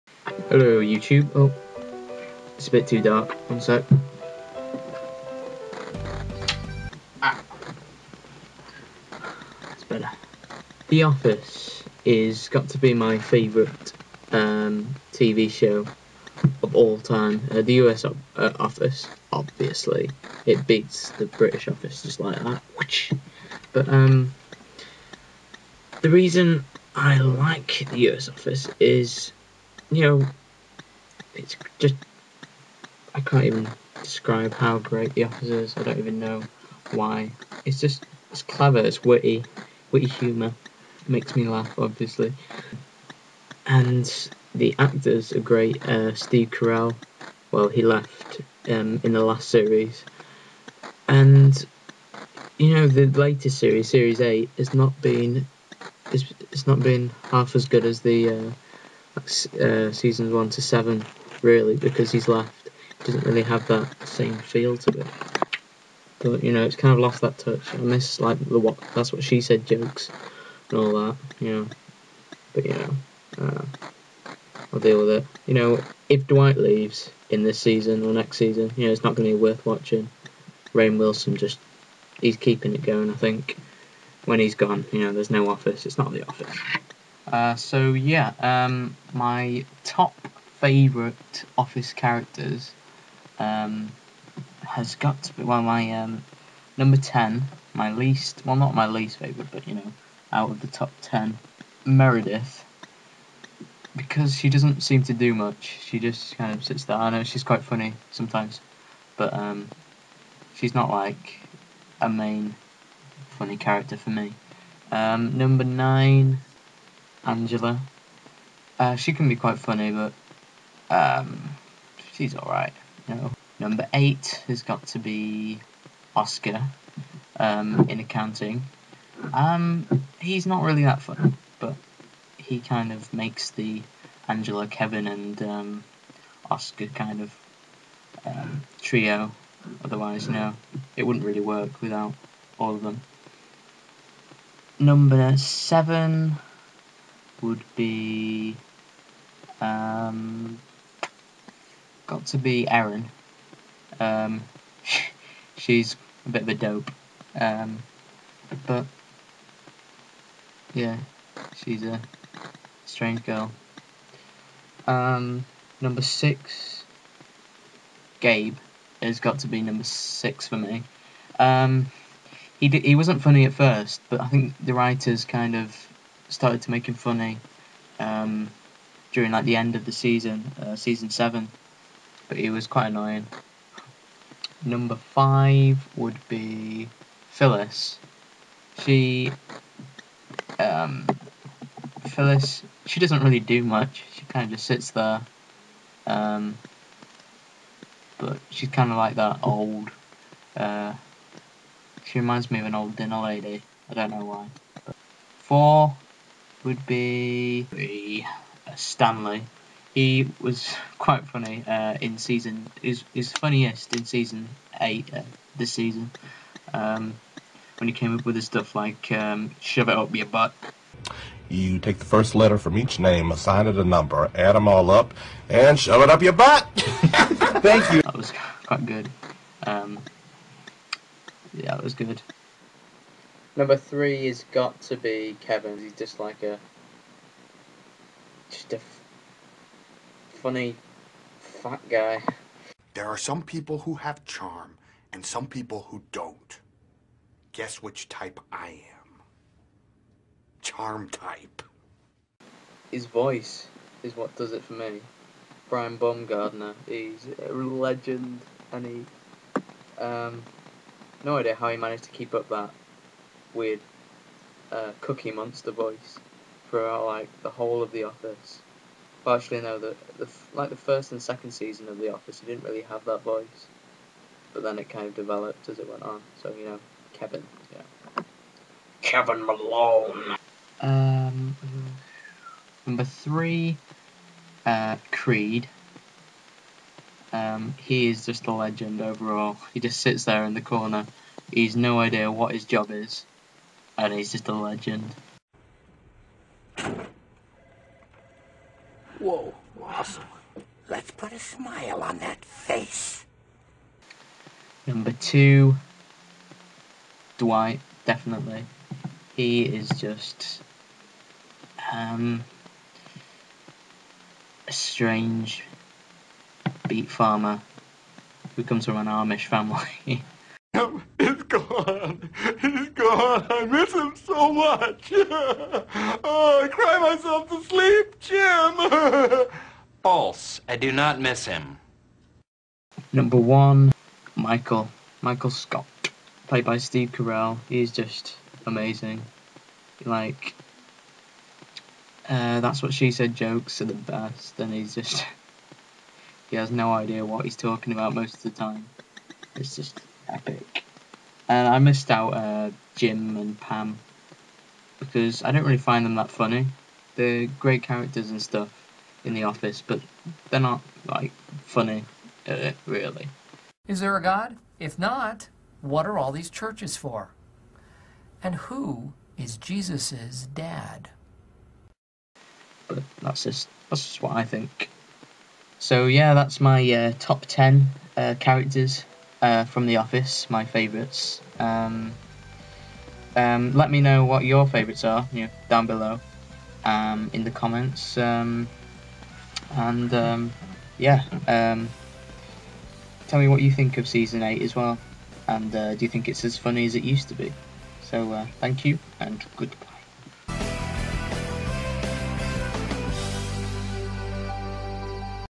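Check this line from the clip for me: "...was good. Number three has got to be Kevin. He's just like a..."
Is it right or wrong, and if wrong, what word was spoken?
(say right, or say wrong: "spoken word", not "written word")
right.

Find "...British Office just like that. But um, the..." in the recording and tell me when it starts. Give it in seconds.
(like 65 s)
21 s.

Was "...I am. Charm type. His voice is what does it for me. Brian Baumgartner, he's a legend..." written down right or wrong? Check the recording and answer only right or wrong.
right.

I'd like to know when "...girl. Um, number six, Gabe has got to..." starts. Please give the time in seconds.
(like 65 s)
163 s.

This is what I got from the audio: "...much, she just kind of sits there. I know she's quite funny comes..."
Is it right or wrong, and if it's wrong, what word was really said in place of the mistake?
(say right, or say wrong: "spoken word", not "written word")
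wrong: "sometimes", not "comes".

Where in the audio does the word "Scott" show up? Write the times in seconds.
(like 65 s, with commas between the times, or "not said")
335 s.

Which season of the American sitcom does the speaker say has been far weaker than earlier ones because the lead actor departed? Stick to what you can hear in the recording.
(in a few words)
Series 8.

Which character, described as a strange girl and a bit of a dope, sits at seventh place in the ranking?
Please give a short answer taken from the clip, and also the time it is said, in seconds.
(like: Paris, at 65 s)
Erin, at 152 s.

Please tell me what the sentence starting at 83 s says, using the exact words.
I think when he's gone, you know, there's no office.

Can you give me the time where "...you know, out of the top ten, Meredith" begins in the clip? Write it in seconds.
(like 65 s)
99 s.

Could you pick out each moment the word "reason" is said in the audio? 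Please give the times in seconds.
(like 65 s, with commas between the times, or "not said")
26 s.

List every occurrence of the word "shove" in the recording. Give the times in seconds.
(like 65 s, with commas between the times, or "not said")
219 s, 225 s.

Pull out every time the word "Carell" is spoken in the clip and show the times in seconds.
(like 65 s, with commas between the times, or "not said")
46 s, 337 s.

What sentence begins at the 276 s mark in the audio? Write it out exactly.
So you know, Kevin, yeah, Kevin Malone.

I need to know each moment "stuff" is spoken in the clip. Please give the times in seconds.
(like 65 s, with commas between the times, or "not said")
218 s, 358 s.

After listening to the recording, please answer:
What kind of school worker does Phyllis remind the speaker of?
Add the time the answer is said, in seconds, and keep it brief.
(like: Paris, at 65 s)
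Dinner lady, at 202 s.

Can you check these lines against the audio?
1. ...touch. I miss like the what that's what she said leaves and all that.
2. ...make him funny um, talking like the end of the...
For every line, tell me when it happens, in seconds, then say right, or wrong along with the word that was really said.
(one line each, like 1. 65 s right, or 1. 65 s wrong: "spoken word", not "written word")
1. 67 s wrong: "jokes", not "leaves"
2. 176 s wrong: "during", not "talking".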